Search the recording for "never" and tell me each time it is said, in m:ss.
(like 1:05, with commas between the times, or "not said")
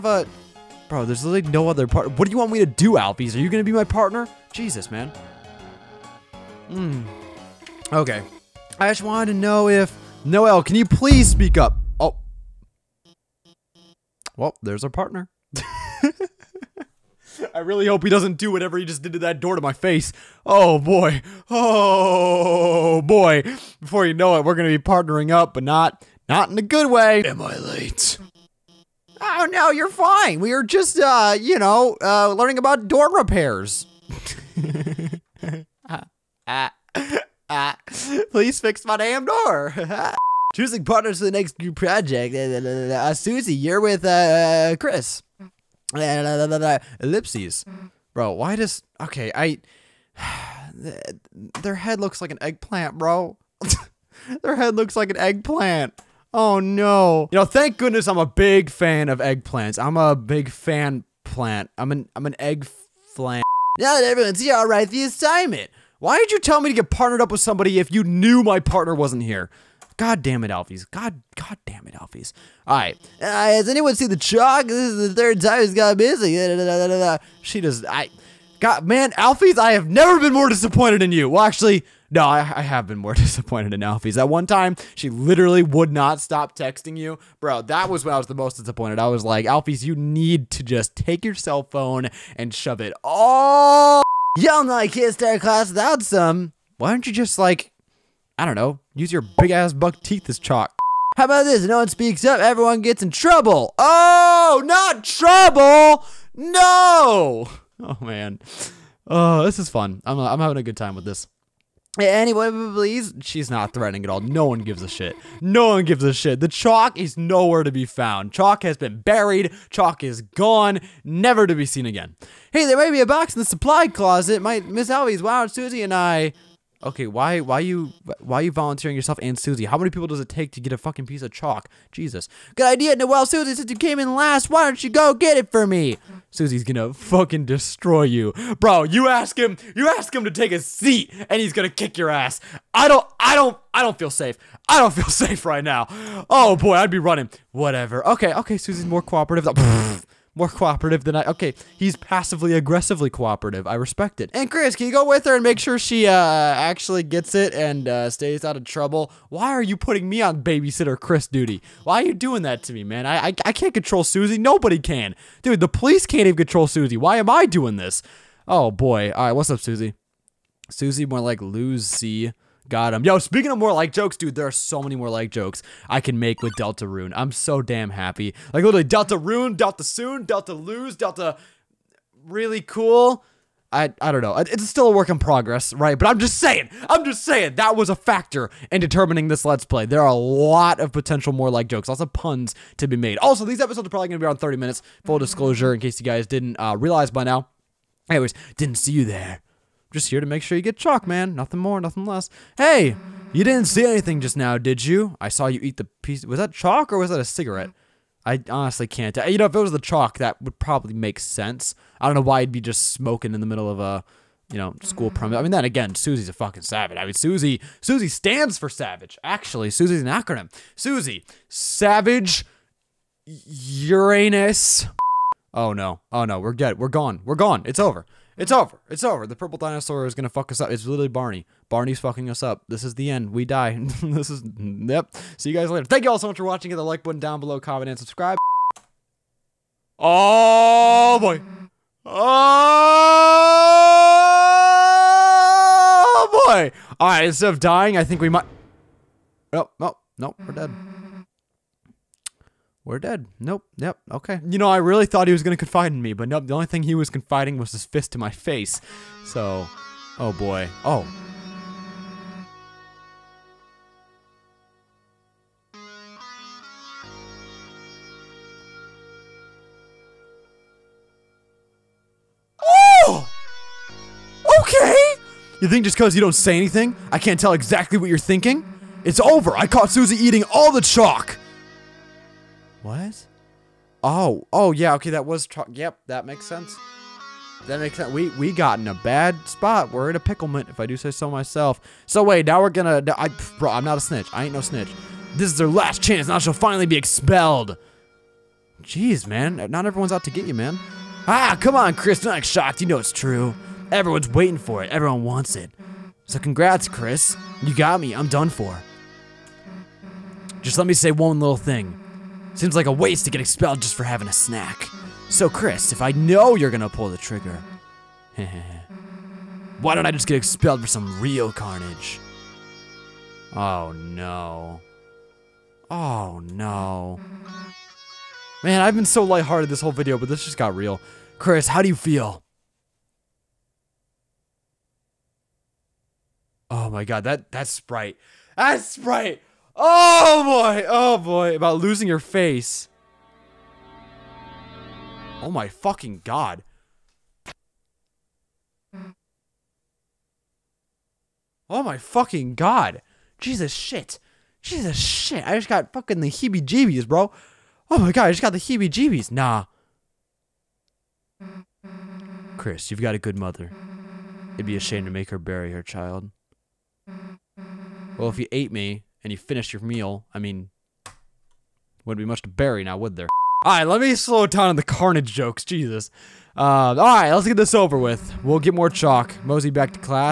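1:19, 2:01.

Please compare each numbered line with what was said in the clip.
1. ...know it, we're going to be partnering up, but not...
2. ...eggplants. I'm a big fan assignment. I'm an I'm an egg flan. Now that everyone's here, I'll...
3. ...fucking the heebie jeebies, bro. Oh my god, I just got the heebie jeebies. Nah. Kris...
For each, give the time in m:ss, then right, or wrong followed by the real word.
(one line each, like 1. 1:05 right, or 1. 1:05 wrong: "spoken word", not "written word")
1. 0:24 right
2. 0:59 wrong: "plant", not "assignment"
3. 5:55 right.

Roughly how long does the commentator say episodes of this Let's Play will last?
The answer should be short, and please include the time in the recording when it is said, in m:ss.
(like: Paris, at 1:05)
30 minutes, at 3:14.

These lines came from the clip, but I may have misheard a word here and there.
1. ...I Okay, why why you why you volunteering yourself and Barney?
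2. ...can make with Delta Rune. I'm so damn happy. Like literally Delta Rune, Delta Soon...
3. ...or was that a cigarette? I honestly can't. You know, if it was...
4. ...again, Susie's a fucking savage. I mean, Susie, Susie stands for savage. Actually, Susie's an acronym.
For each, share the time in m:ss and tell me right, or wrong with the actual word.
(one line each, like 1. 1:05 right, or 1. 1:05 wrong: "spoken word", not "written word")
1. 2:05 wrong: "Susie", not "Barney"
2. 2:56 right
3. 3:26 right
4. 3:35 right.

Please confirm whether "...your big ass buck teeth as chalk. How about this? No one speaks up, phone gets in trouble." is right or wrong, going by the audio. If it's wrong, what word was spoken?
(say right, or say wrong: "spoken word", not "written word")
wrong: "everyone", not "phone".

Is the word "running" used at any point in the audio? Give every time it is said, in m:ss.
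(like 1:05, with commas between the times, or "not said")
2:27.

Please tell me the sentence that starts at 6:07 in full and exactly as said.
Well, if you ate me, and you finish your meal, I mean, wouldn't be much to bury now, would there?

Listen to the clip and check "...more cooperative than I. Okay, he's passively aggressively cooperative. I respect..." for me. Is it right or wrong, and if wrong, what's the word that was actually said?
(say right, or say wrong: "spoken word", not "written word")
right.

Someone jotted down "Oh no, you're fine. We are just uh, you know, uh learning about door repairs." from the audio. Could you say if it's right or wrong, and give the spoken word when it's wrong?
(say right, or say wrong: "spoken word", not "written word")
right.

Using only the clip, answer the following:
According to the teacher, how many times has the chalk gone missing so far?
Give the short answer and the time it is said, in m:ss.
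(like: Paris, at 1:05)
Third, at 1:14.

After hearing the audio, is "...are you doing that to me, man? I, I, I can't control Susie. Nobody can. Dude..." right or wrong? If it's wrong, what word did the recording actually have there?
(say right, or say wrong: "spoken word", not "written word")
right.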